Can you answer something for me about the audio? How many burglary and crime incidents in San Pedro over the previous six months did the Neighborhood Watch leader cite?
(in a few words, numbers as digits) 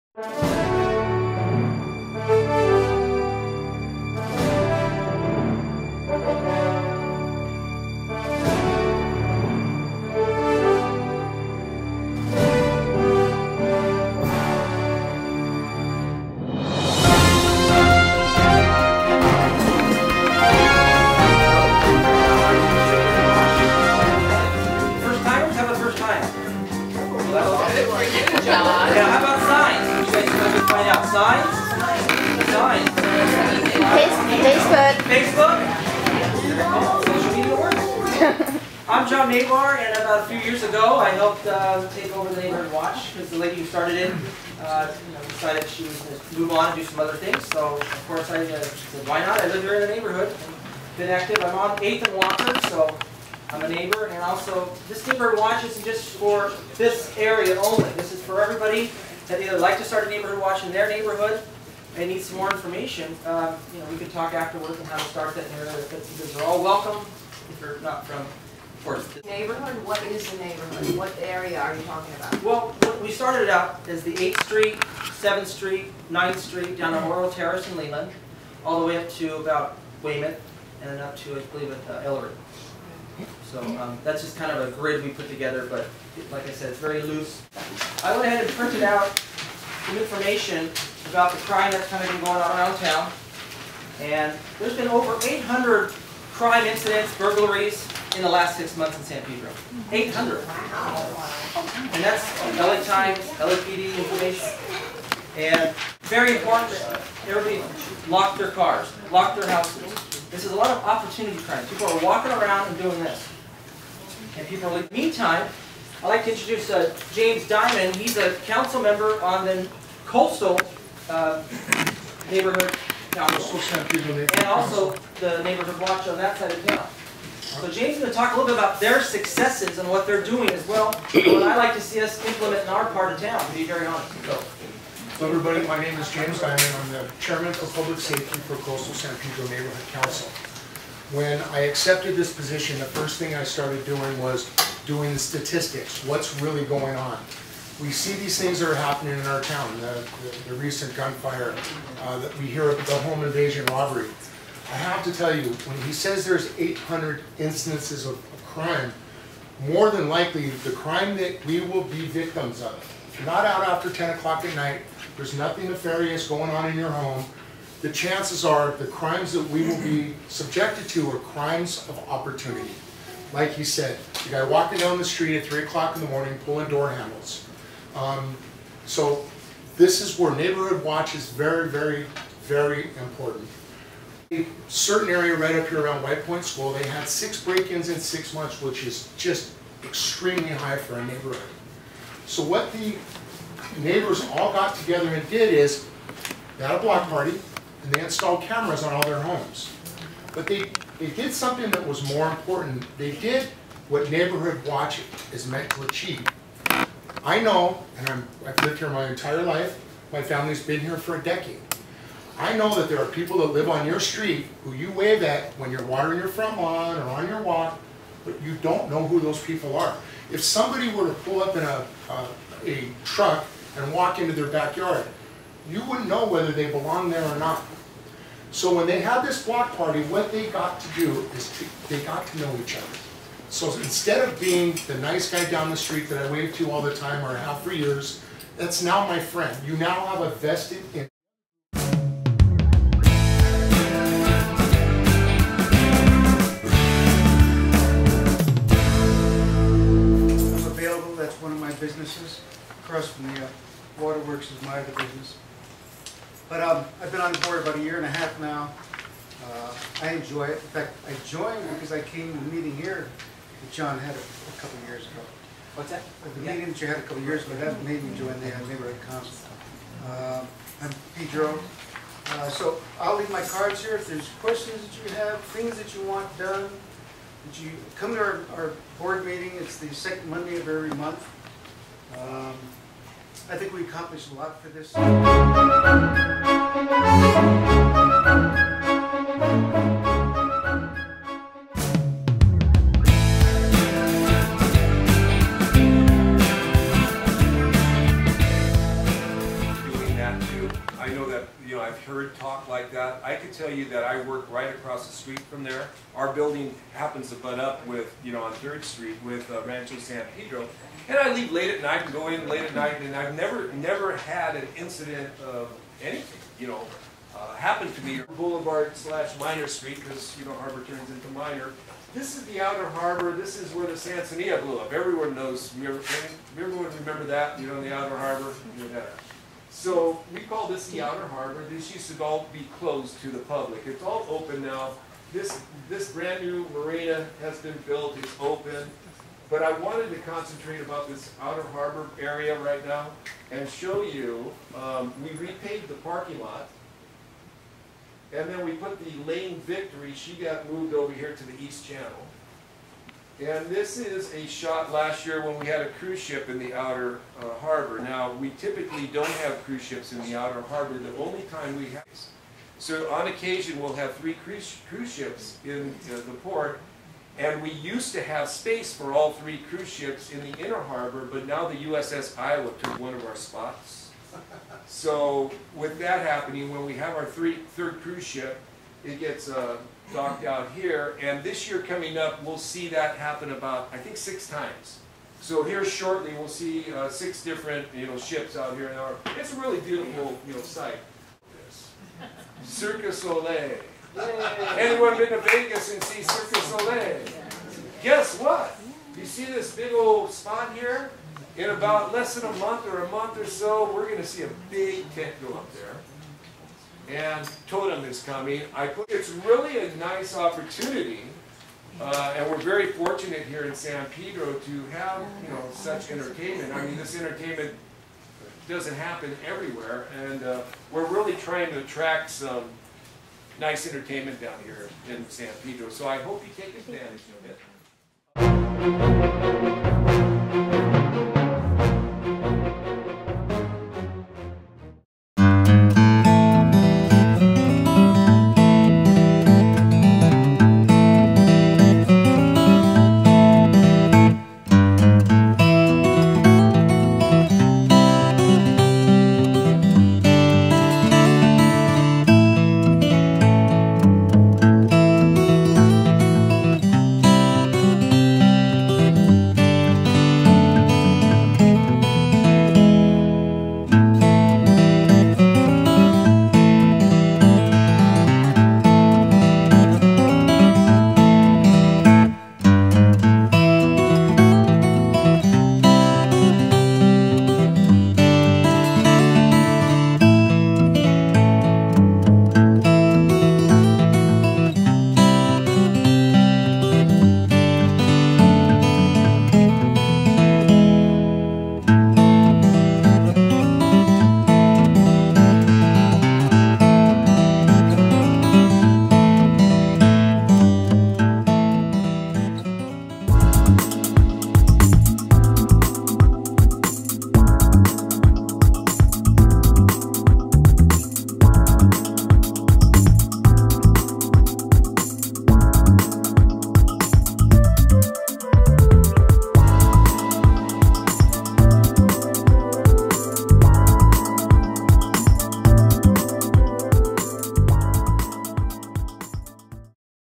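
800.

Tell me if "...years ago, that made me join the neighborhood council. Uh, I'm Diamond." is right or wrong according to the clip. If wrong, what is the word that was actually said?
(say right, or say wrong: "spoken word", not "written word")
wrong: "Pedro", not "Diamond".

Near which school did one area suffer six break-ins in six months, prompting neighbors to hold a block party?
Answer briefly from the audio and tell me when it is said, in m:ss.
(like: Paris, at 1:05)
White Point School, at 3:06.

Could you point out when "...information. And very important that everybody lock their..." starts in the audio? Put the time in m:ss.
1:43.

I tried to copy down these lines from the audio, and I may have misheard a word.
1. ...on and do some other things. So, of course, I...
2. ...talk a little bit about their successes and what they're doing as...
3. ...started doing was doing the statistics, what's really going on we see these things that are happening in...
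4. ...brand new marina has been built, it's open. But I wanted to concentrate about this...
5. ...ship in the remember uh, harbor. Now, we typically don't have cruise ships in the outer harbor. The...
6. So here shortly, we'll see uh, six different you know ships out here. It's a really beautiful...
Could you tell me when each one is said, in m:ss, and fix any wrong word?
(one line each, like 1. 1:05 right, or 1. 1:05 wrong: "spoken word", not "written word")
1. 0:46 right
2. 2:08 right
3. 2:23 right
4. 5:36 right
5. 5:56 wrong: "outer", not "remember"
6. 6:25 right.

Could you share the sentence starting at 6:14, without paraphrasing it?
So with that happening, when we have our three, third cruise ship, it gets uh, docked out here.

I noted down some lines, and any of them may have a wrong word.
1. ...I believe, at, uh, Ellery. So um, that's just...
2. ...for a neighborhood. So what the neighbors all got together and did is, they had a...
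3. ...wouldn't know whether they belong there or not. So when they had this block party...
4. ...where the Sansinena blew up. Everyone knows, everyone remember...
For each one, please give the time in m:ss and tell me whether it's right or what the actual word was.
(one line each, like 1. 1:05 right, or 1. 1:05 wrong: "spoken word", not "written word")
1. 1:21 right
2. 3:10 right
3. 3:45 right
4. 5:23 right.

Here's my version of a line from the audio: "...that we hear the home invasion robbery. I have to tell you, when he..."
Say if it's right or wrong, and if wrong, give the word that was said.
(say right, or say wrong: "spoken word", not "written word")
right.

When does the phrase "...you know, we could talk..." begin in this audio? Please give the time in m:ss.
1:03.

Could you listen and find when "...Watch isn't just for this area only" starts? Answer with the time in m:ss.
0:55.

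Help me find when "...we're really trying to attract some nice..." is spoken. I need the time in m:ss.
7:00.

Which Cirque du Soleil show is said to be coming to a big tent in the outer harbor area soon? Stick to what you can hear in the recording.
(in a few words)
Totem.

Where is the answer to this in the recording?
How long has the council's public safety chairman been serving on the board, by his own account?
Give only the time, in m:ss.
4:17.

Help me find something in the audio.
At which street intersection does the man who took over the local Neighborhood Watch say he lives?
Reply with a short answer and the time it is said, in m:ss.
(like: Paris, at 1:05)
8th and Walker, at 0:51.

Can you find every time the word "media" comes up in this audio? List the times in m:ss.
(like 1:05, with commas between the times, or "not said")
0:37.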